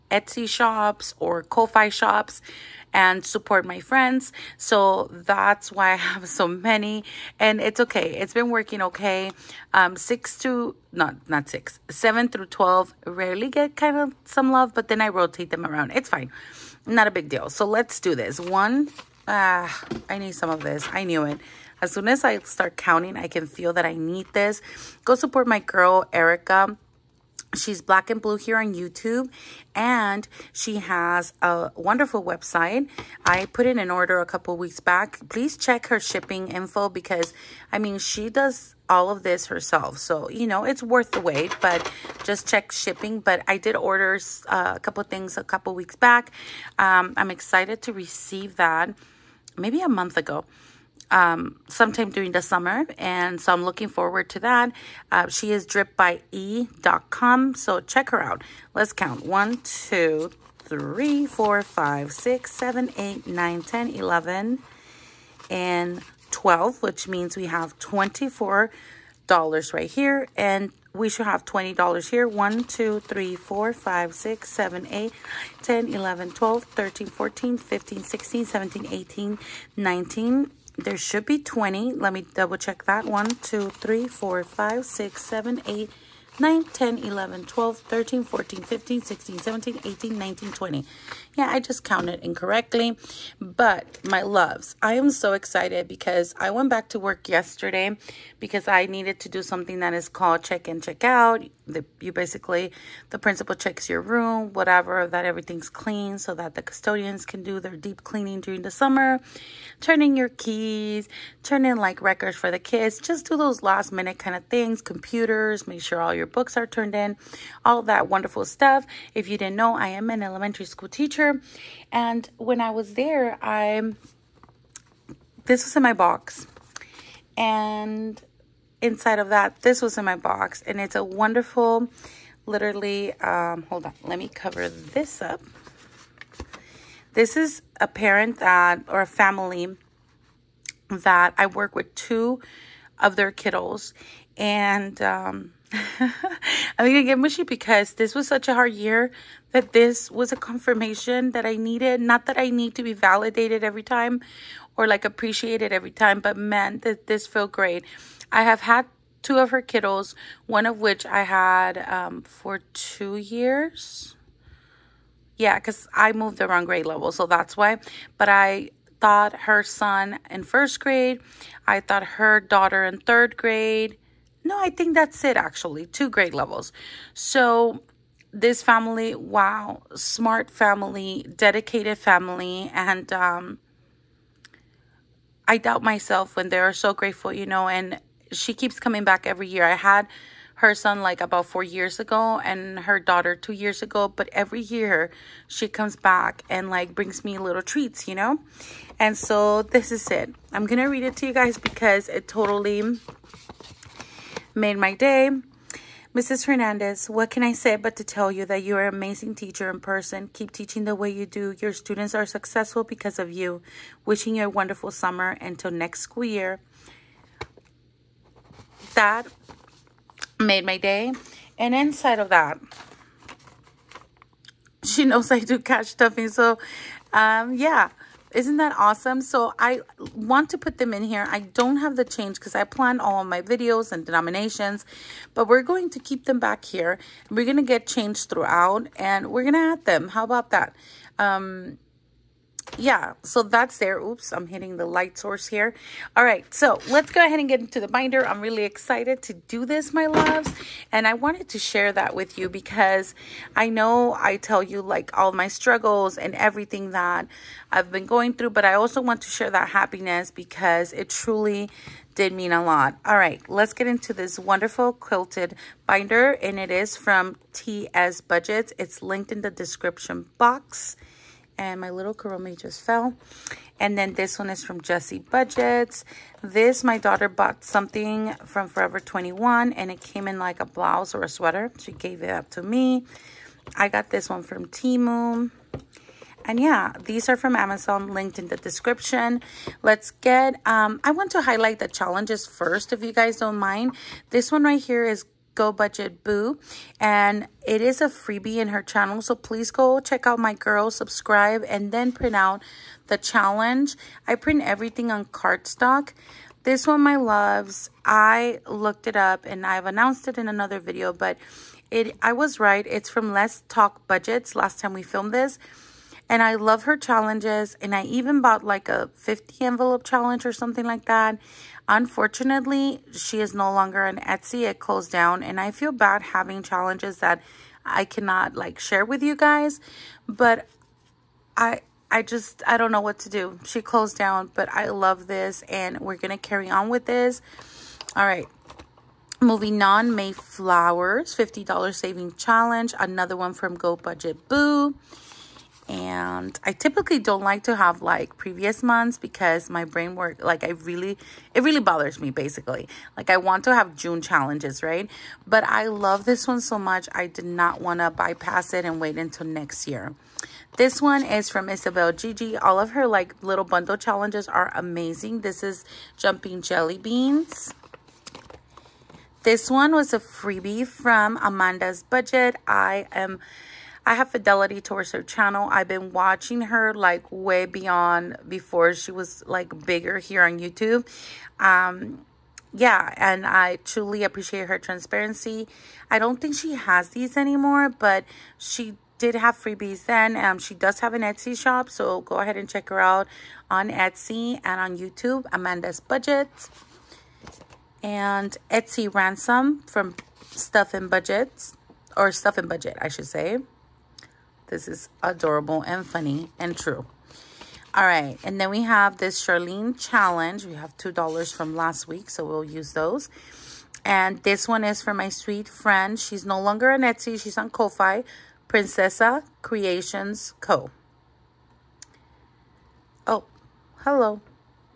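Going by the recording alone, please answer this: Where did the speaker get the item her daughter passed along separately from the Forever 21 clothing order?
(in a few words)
Temu.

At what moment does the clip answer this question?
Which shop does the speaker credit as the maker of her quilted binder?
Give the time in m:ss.
4:27.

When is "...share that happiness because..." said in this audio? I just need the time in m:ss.
4:19.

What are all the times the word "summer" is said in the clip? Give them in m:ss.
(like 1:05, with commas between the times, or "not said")
0:52, 1:48, 3:34.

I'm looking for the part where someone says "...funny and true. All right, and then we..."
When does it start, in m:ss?
6:46.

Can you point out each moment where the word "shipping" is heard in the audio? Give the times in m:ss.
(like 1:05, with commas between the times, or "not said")
0:35, 0:42.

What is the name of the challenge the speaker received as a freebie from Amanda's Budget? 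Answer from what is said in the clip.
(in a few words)
jumping jelly beans.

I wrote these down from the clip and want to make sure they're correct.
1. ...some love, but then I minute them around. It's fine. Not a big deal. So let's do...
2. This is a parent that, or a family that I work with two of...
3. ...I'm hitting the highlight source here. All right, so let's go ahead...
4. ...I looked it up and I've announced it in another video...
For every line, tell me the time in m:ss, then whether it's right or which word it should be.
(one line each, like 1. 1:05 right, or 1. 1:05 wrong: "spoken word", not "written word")
1. 0:14 wrong: "rotate", not "minute"
2. 2:17 right
3. 4:04 wrong: "light", not "highlight"
4. 5:08 right.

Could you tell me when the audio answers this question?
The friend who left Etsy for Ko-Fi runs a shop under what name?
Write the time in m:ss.
6:58.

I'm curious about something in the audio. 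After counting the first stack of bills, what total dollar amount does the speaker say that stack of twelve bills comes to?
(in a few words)
$24.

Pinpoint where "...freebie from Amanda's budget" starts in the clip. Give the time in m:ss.
6:10.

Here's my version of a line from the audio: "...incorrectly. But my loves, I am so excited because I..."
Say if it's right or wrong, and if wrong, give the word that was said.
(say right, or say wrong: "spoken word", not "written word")
right.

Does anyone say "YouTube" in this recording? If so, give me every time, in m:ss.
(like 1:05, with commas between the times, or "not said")
0:28, 6:20, 6:34.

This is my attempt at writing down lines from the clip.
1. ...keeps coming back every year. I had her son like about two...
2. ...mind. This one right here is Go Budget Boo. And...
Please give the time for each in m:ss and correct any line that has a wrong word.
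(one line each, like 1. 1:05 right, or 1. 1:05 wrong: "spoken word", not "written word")
1. 3:08 wrong: "four", not "two"
2. 4:53 right.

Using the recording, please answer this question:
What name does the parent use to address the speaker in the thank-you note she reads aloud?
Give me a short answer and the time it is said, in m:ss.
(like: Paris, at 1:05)
Mrs. Hernandez, at 3:26.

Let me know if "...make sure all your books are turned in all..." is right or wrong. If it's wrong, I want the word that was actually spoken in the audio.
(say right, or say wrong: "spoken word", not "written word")
right.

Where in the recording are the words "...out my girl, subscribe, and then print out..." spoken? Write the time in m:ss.
5:00.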